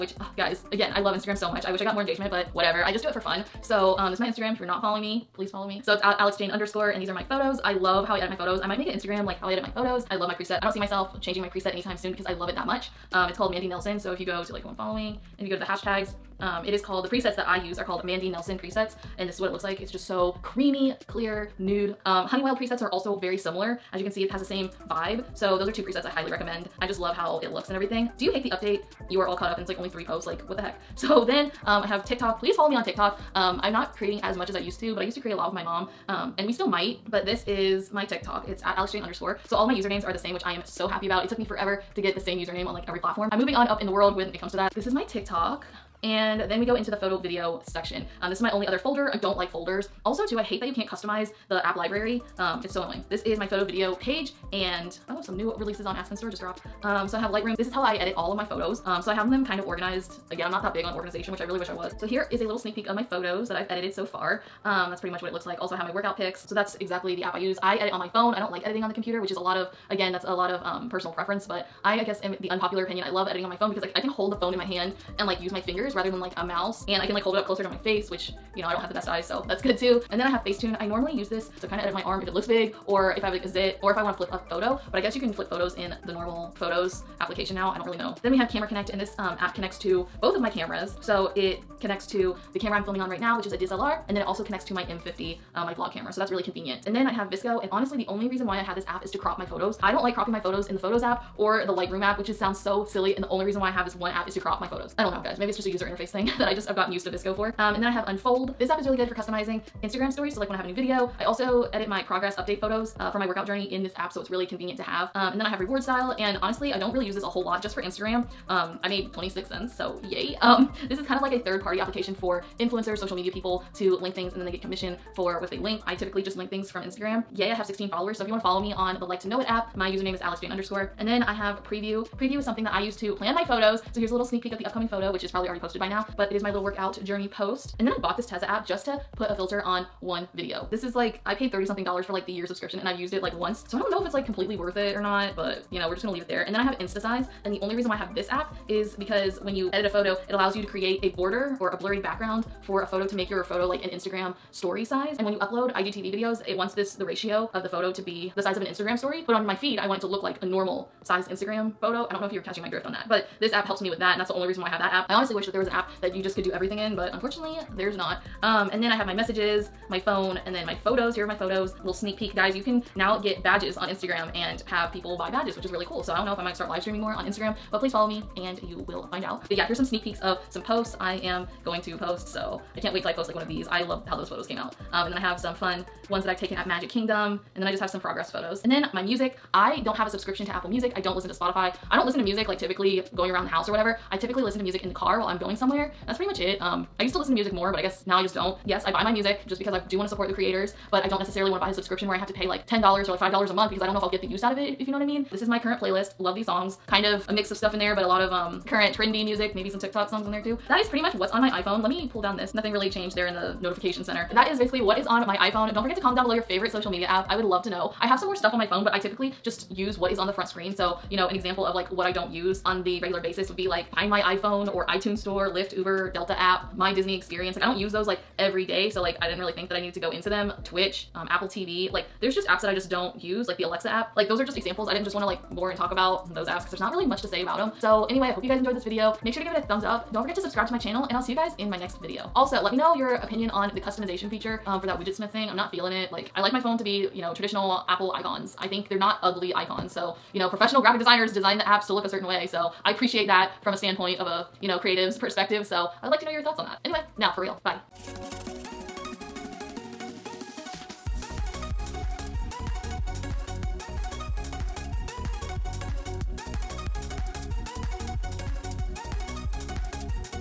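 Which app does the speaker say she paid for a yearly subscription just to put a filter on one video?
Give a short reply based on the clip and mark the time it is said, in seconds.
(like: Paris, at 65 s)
Tezza, at 138 s.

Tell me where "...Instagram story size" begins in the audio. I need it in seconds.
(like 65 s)
153 s.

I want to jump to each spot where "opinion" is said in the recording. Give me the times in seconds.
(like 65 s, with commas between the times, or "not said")
72 s, 243 s.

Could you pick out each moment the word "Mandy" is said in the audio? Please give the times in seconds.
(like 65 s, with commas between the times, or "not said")
13 s, 18 s.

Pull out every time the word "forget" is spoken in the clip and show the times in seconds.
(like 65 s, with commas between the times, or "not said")
215 s, 240 s.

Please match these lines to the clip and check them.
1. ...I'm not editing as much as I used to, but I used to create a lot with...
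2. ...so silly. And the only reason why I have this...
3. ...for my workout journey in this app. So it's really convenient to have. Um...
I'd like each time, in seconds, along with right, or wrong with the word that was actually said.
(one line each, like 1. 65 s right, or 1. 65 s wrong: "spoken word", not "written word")
1. 33 s wrong: "creating", not "editing"
2. 102 s right
3. 113 s right.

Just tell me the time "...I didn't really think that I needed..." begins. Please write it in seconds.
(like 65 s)
229 s.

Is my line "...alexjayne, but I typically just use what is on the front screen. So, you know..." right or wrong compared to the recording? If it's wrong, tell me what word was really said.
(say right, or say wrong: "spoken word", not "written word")
wrong: "phone", not "alexjayne".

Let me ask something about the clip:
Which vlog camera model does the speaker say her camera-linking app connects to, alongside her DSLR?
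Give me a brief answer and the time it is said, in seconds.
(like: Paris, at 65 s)
M50, at 94 s.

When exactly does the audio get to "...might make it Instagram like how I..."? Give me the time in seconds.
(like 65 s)
8 s.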